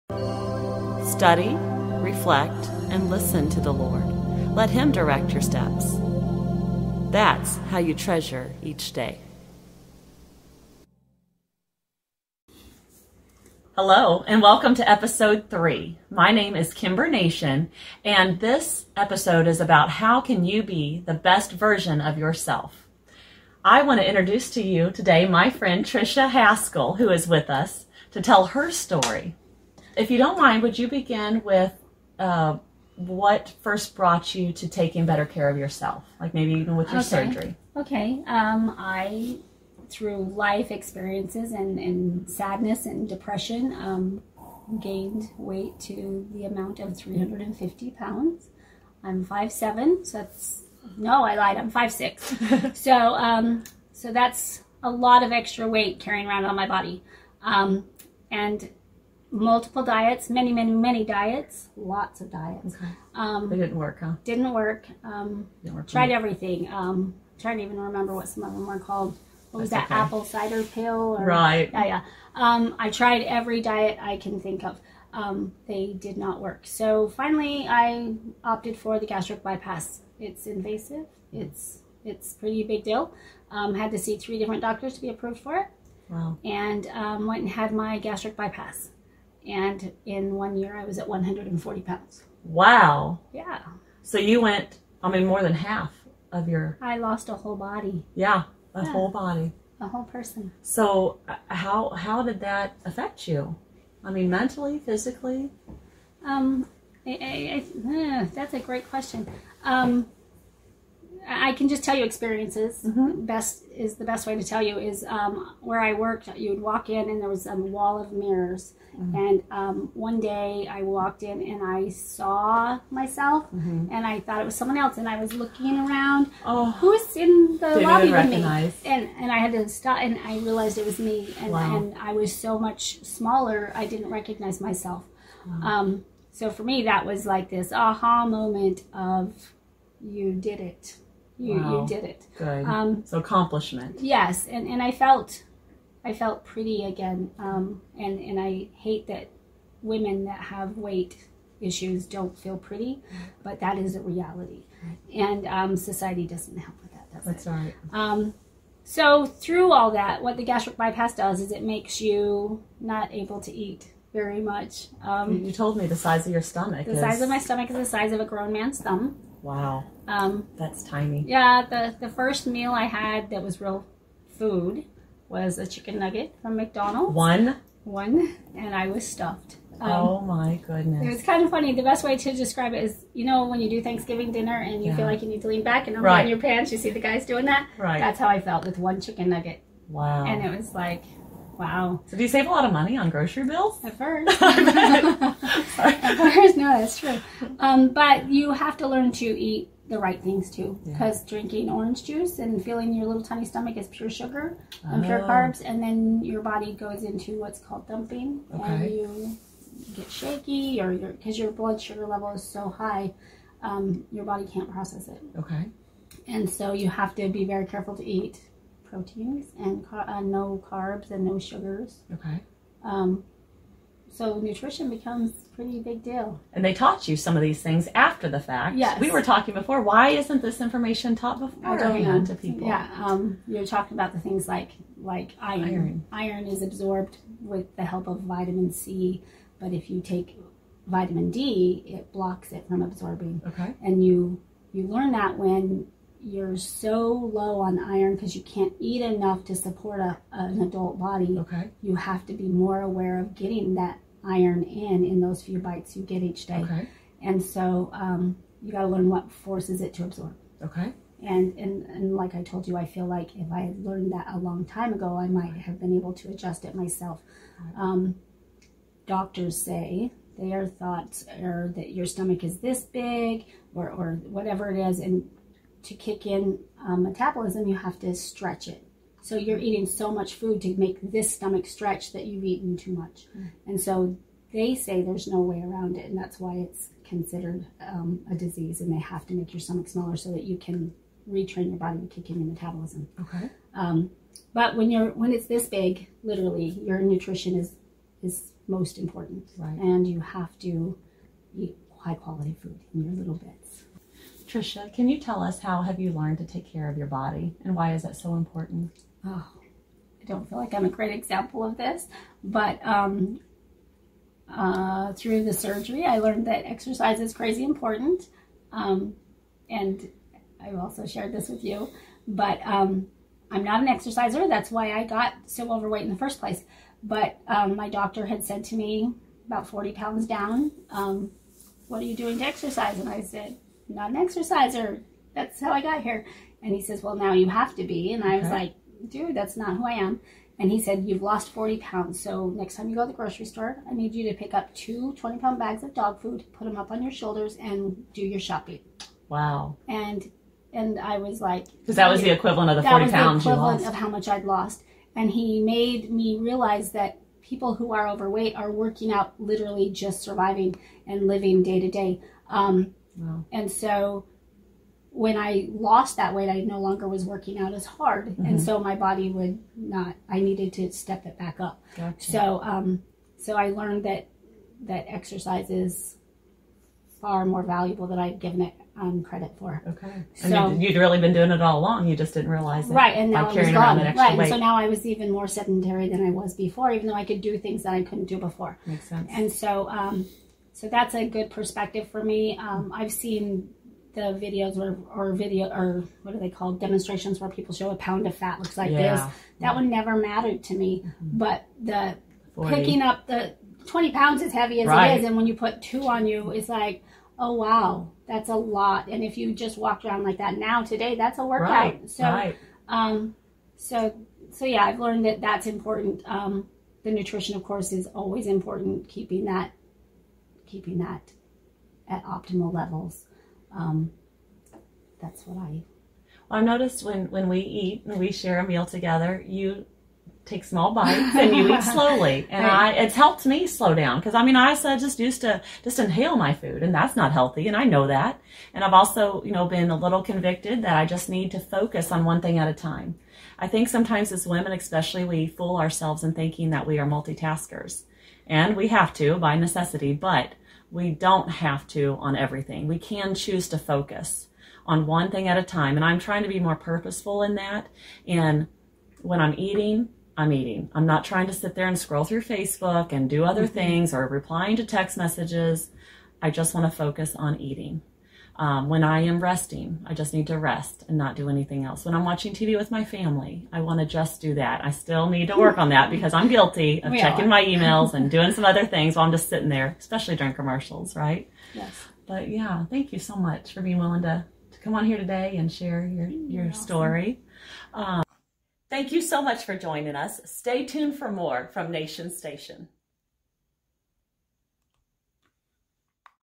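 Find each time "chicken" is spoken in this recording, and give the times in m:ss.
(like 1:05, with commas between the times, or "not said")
2:55, 3:09.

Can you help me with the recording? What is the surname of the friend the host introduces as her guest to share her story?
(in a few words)
Haskell.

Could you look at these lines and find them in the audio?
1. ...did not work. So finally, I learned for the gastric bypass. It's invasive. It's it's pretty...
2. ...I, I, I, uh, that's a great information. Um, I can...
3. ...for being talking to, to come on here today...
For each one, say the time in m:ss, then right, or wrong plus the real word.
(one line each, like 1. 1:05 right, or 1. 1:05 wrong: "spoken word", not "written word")
1. 1:15 wrong: "opted", not "learned"
2. 1:47 wrong: "question", not "information"
3. 8:03 wrong: "willing", not "talking".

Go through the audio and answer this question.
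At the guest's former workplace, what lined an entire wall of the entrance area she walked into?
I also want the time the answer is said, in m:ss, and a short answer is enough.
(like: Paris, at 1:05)
Mirrors, at 1:58.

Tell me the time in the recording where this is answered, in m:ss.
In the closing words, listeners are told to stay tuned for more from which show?
8:11.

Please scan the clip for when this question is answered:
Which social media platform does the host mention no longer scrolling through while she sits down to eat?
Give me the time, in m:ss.
7:42.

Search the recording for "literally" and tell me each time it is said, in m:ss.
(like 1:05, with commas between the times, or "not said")
4:56, 5:59.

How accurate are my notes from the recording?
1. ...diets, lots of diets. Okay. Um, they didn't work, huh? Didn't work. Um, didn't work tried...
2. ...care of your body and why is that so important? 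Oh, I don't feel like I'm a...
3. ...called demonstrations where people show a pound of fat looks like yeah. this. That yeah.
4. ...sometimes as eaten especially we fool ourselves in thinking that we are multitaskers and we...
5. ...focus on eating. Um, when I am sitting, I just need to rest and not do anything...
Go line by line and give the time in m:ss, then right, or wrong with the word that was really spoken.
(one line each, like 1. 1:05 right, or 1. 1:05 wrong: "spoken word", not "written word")
1. 1:01 right
2. 5:06 right
3. 6:36 right
4. 7:23 wrong: "women", not "eaten"
5. 7:46 wrong: "resting", not "sitting".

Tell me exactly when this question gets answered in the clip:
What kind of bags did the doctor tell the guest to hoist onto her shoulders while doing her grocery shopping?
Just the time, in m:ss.
5:45.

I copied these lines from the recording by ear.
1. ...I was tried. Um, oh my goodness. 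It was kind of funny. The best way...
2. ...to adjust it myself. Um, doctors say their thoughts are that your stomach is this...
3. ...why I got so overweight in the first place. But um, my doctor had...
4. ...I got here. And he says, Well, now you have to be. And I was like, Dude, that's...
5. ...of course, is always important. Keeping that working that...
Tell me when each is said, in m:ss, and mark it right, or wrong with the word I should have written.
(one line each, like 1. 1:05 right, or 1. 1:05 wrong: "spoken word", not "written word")
1. 2:58 wrong: "stuffed", not "tried"
2. 4:26 right
3. 5:24 right
4. 5:35 right
5. 6:57 wrong: "keeping", not "working".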